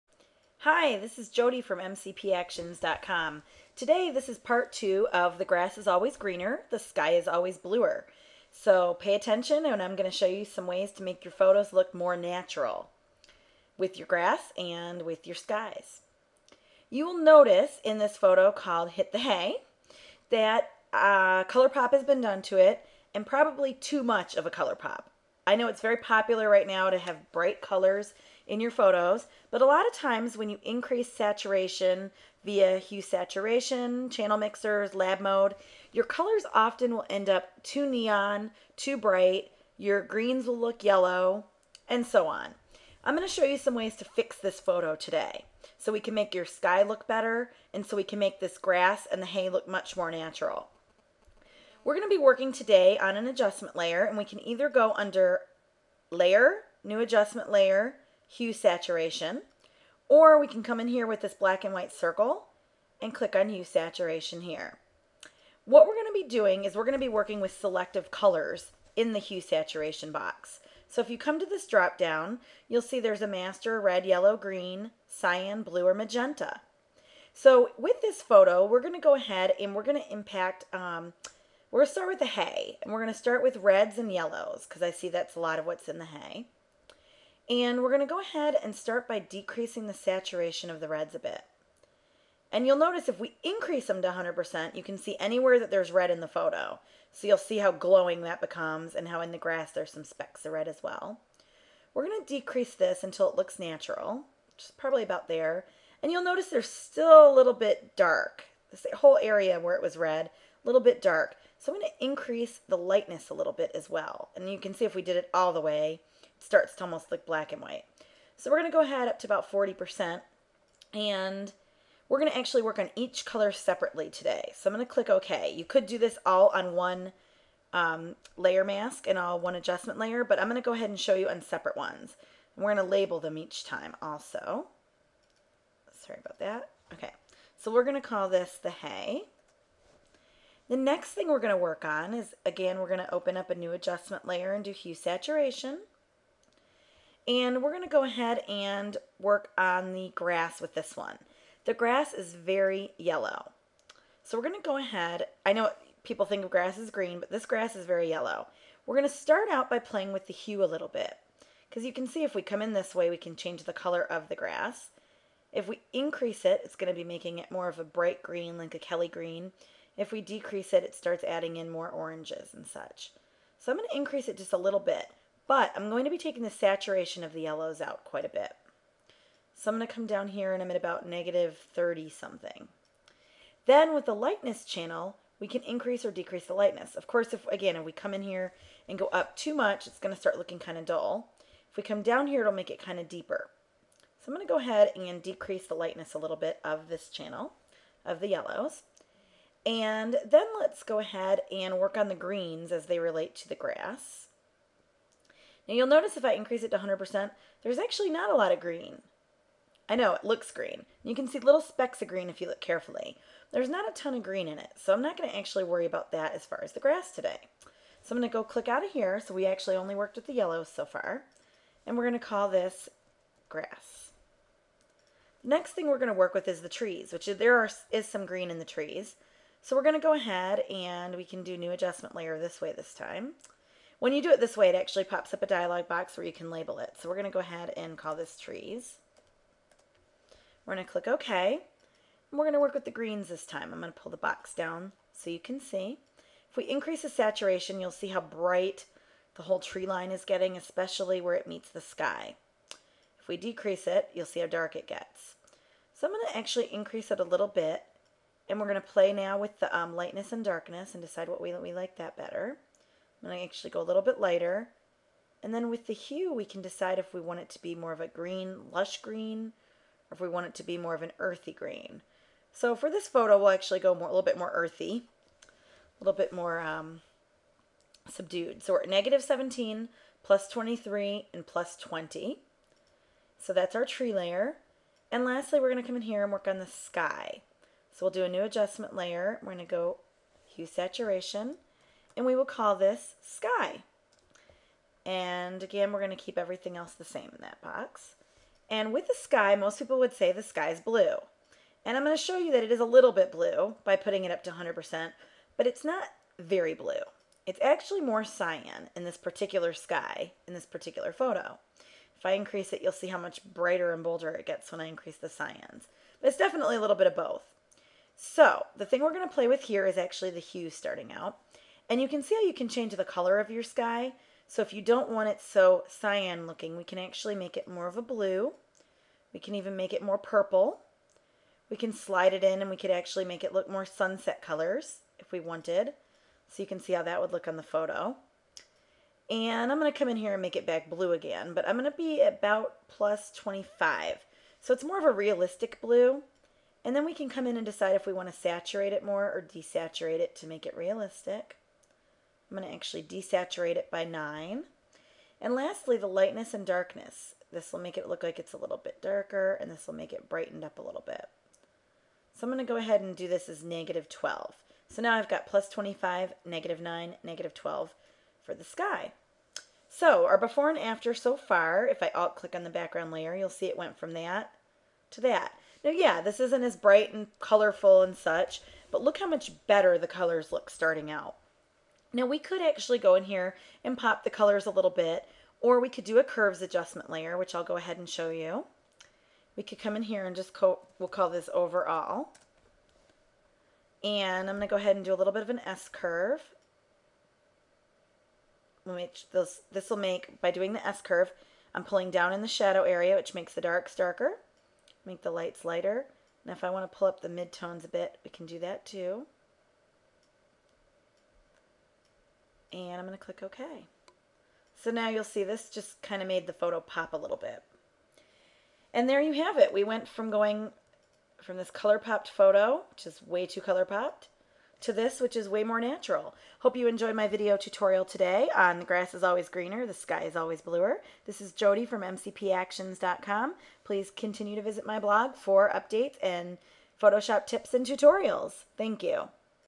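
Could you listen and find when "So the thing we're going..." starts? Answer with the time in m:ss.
5:18.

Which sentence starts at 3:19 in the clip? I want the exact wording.
And then let's go ahead and work on the greens as they relate to the grass.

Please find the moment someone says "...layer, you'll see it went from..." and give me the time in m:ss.
6:13.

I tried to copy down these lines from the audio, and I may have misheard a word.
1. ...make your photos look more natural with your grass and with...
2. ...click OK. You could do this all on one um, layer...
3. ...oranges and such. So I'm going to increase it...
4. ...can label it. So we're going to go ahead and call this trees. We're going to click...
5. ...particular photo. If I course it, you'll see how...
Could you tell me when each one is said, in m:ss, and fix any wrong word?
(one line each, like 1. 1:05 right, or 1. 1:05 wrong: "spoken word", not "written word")
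1. 0:11 right
2. 2:04 right
3. 2:51 right
4. 3:56 right
5. 5:10 wrong: "increase", not "course".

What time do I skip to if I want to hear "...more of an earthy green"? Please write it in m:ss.
4:30.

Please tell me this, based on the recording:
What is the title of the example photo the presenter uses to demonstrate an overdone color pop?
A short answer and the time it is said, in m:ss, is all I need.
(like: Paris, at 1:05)
Hit the Hay, at 0:18.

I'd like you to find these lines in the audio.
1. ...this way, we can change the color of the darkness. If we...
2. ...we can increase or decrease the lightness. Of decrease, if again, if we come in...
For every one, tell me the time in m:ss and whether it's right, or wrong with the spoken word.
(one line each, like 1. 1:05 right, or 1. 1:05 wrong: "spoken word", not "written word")
1. 2:42 wrong: "grass", not "darkness"
2. 3:05 wrong: "course", not "decrease".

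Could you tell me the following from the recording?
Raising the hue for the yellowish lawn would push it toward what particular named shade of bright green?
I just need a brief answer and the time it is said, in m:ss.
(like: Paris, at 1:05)
Kelly green, at 2:48.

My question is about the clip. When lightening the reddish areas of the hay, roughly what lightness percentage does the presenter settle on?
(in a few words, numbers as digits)
40%.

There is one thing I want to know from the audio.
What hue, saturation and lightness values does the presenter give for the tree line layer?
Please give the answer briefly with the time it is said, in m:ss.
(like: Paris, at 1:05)
-17, +23, +20, at 4:38.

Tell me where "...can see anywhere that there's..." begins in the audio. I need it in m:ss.
1:34.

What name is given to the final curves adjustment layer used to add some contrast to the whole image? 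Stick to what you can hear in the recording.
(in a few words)
overall.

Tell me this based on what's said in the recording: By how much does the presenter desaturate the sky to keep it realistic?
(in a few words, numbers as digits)
9.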